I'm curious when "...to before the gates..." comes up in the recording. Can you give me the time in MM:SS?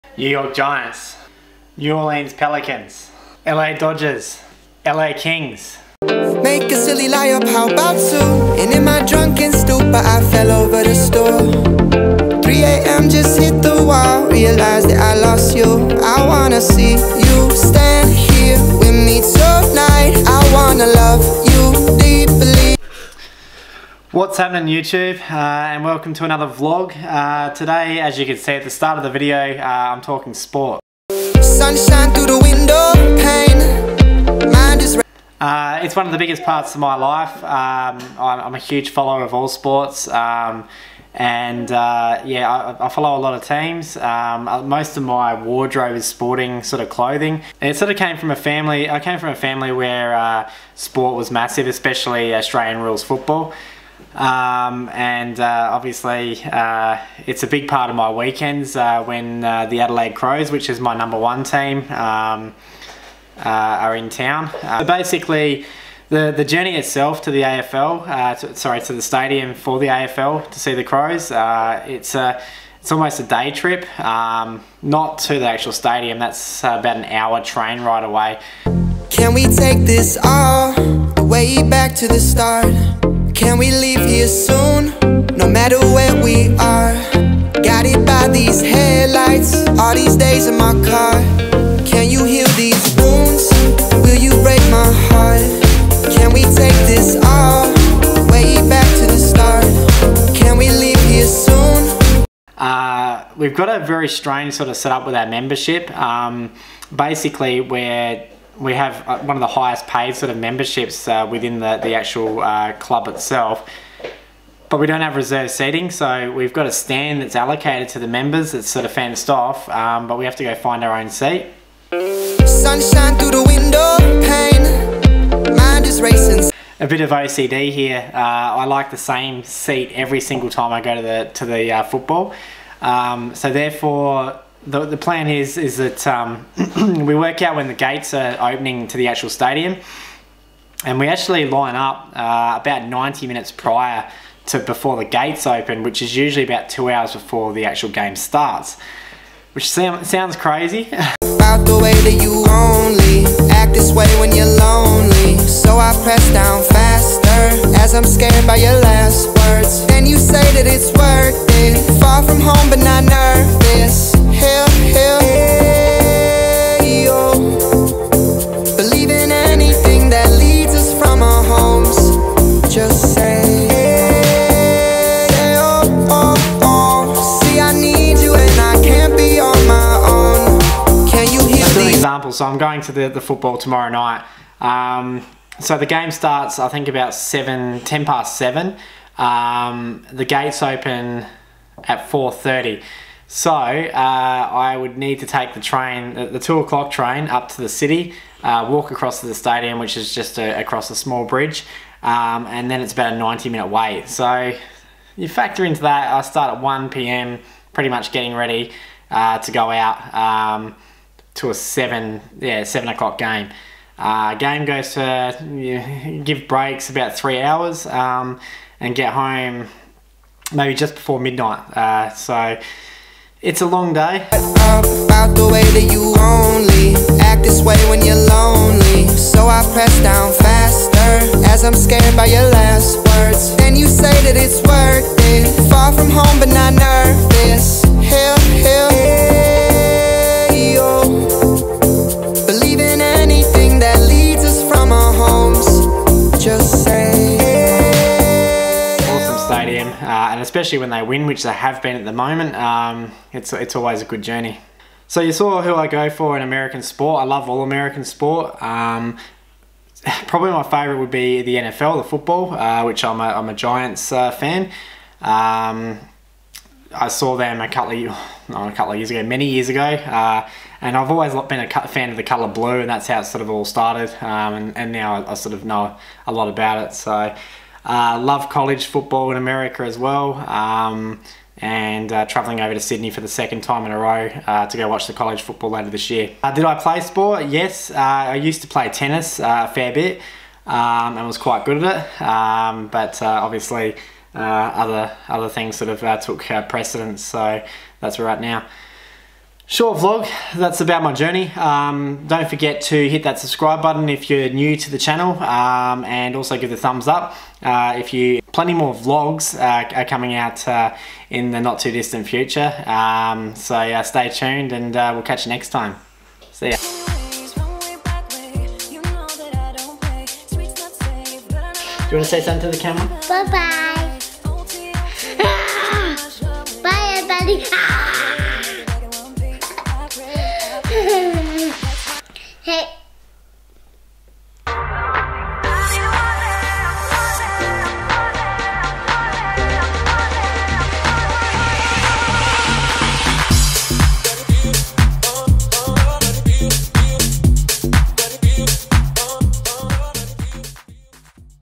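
02:24.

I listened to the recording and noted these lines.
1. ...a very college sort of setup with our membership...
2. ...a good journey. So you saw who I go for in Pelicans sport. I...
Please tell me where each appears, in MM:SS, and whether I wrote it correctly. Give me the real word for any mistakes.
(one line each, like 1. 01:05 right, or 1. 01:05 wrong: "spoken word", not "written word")
1. 01:43 wrong: "strange", not "college"
2. 04:14 wrong: "American", not "Pelicans".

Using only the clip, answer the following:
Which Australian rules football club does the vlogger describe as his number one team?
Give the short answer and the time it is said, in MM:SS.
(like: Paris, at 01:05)
Adelaide Crows, at 00:59.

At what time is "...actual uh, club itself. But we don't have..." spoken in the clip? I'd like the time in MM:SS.
01:51.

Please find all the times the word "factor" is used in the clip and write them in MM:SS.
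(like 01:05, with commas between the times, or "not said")
03:25.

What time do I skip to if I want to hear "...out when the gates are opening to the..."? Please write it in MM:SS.
02:17.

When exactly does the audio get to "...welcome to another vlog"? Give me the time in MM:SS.
00:25.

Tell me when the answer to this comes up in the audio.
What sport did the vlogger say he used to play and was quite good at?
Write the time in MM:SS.
04:48.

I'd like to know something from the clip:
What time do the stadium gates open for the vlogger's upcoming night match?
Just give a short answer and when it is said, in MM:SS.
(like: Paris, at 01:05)
4:30, at 03:12.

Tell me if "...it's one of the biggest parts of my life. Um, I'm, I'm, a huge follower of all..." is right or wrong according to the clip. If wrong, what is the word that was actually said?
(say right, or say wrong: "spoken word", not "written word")
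right.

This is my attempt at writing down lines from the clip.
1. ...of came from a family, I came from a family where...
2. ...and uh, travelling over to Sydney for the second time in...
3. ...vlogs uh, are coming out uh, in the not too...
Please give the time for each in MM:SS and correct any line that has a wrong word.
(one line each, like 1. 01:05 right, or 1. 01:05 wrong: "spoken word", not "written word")
1. 00:47 right
2. 04:41 right
3. 05:08 right.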